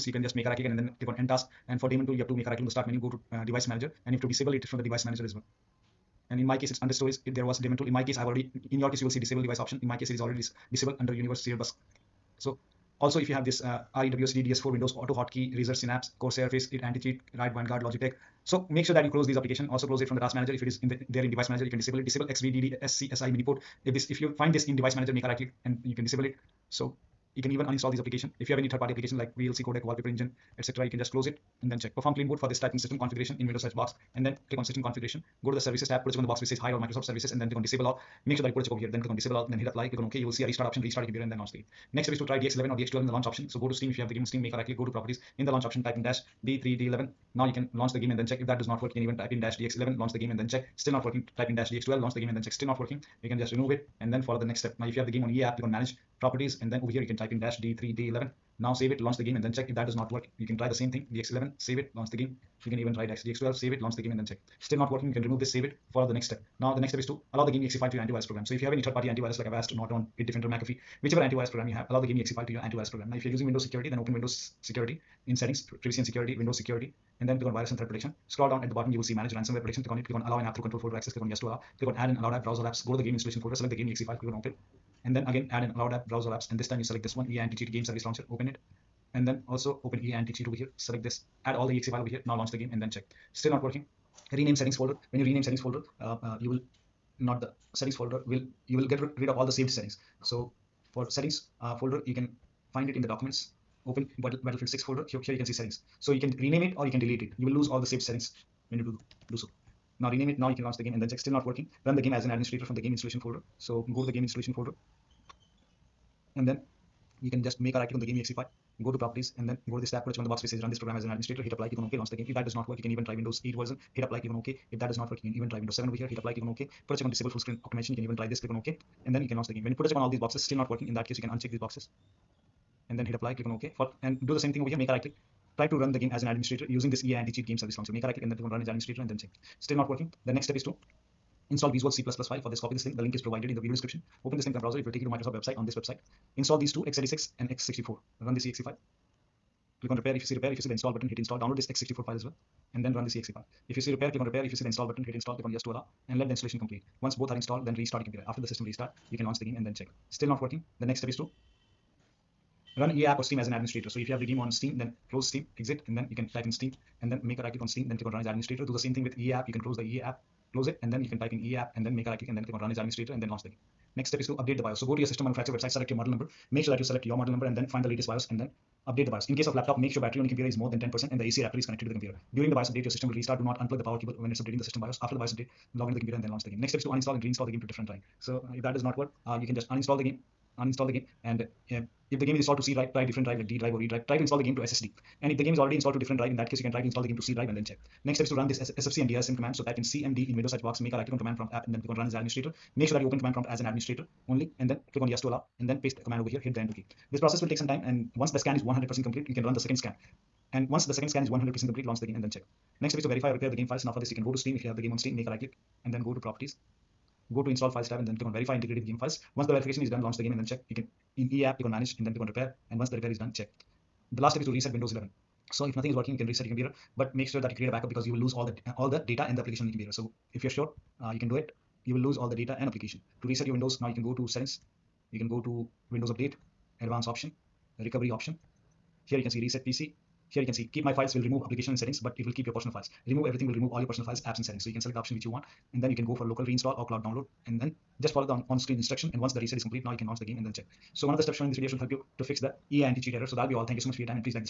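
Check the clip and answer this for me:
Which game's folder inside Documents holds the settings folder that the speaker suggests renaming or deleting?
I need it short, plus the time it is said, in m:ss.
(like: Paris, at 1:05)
Battlefield 6, at 1:44.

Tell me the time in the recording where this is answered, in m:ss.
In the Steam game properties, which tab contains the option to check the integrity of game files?
3:37.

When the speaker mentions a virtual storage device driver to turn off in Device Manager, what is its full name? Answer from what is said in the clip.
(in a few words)
XVDD SCSI Miniport.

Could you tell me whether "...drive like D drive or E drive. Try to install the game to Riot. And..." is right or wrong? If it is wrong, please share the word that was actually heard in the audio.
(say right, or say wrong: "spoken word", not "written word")
wrong: "SSD", not "Riot".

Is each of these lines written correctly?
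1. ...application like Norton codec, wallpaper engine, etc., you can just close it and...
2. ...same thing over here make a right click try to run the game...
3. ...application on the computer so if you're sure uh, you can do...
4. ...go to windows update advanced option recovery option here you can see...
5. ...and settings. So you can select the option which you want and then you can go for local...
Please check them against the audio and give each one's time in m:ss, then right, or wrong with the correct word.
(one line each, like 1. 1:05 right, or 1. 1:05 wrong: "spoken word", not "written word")
1. 0:28 wrong: "VLC", not "Norton"
2. 2:14 right
3. 3:49 right
4. 3:55 right
5. 4:04 right.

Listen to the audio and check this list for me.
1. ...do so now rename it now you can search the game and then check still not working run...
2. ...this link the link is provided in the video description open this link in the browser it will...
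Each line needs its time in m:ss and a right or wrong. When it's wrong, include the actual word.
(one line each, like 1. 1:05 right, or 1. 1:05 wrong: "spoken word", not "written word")
1. 1:49 wrong: "launch", not "search"
2. 2:22 right.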